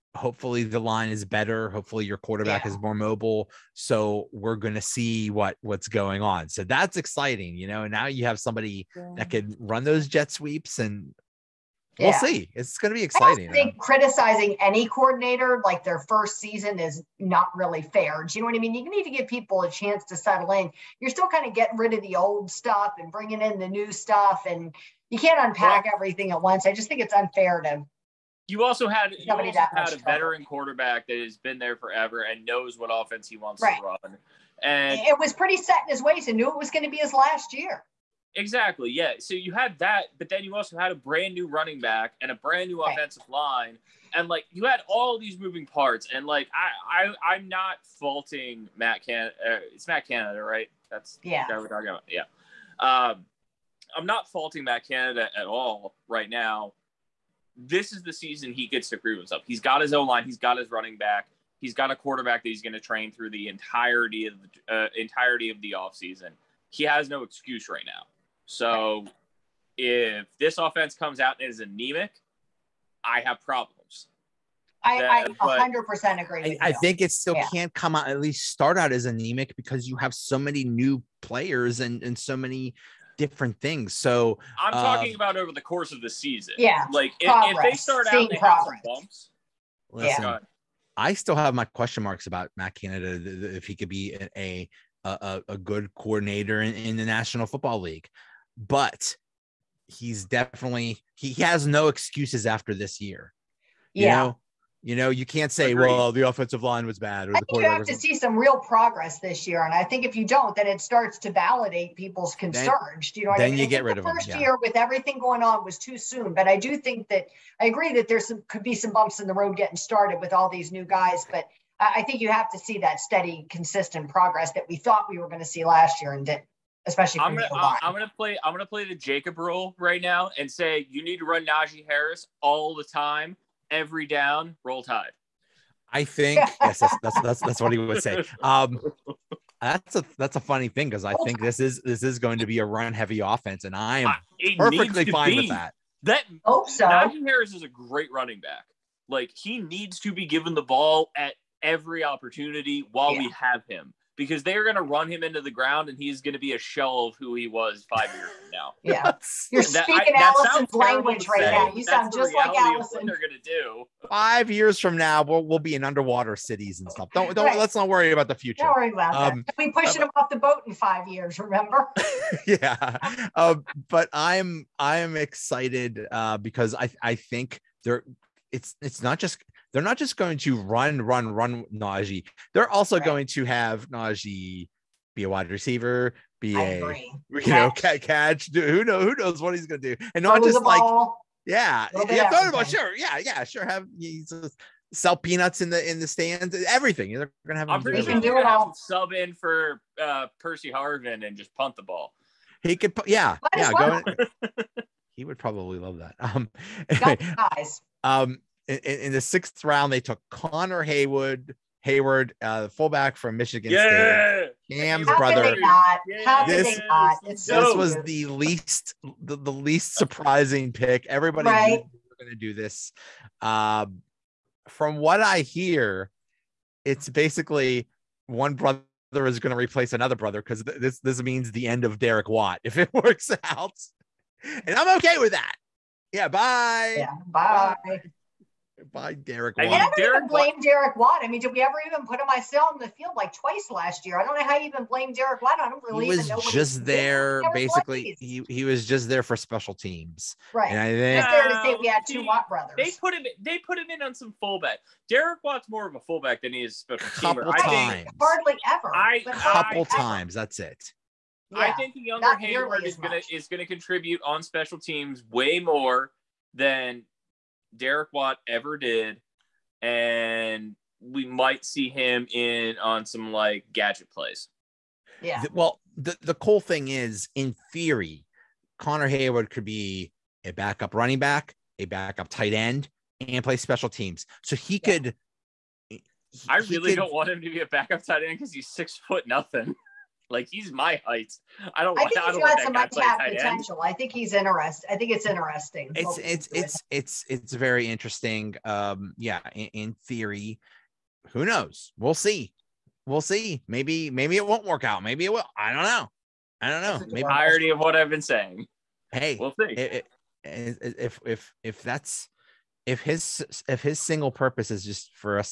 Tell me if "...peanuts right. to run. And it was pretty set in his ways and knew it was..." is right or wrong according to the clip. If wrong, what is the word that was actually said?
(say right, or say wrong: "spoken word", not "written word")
wrong: "wants", not "peanuts".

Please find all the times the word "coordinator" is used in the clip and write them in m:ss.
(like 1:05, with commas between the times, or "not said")
0:14, 1:35.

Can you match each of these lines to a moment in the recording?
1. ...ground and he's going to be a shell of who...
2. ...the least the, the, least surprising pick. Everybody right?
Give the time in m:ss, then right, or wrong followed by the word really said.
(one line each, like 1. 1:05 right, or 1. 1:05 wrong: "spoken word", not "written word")
1. 2:35 right
2. 3:38 right.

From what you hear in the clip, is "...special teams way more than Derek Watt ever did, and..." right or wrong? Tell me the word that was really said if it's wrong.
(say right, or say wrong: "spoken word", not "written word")
right.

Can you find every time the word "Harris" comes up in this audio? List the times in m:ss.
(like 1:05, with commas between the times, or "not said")
2:11, 2:27.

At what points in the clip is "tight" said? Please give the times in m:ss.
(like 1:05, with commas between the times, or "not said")
4:42, 4:48.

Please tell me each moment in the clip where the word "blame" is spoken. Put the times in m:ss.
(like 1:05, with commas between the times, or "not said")
4:00, 4:04.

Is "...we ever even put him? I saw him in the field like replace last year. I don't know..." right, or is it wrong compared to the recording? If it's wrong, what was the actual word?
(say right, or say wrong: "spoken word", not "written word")
wrong: "twice", not "replace".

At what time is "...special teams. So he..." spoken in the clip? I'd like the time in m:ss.
4:43.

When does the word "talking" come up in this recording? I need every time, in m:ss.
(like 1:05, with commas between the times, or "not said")
0:51, 1:24.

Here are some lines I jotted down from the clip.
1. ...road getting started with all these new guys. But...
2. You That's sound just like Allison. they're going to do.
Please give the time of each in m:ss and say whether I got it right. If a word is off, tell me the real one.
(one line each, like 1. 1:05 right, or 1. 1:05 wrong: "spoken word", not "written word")
1. 1:59 right
2. 2:41 right.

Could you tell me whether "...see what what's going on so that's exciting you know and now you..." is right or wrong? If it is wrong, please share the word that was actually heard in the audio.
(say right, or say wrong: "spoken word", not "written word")
right.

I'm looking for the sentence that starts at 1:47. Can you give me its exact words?
Or I the think you have to see some real progress this year.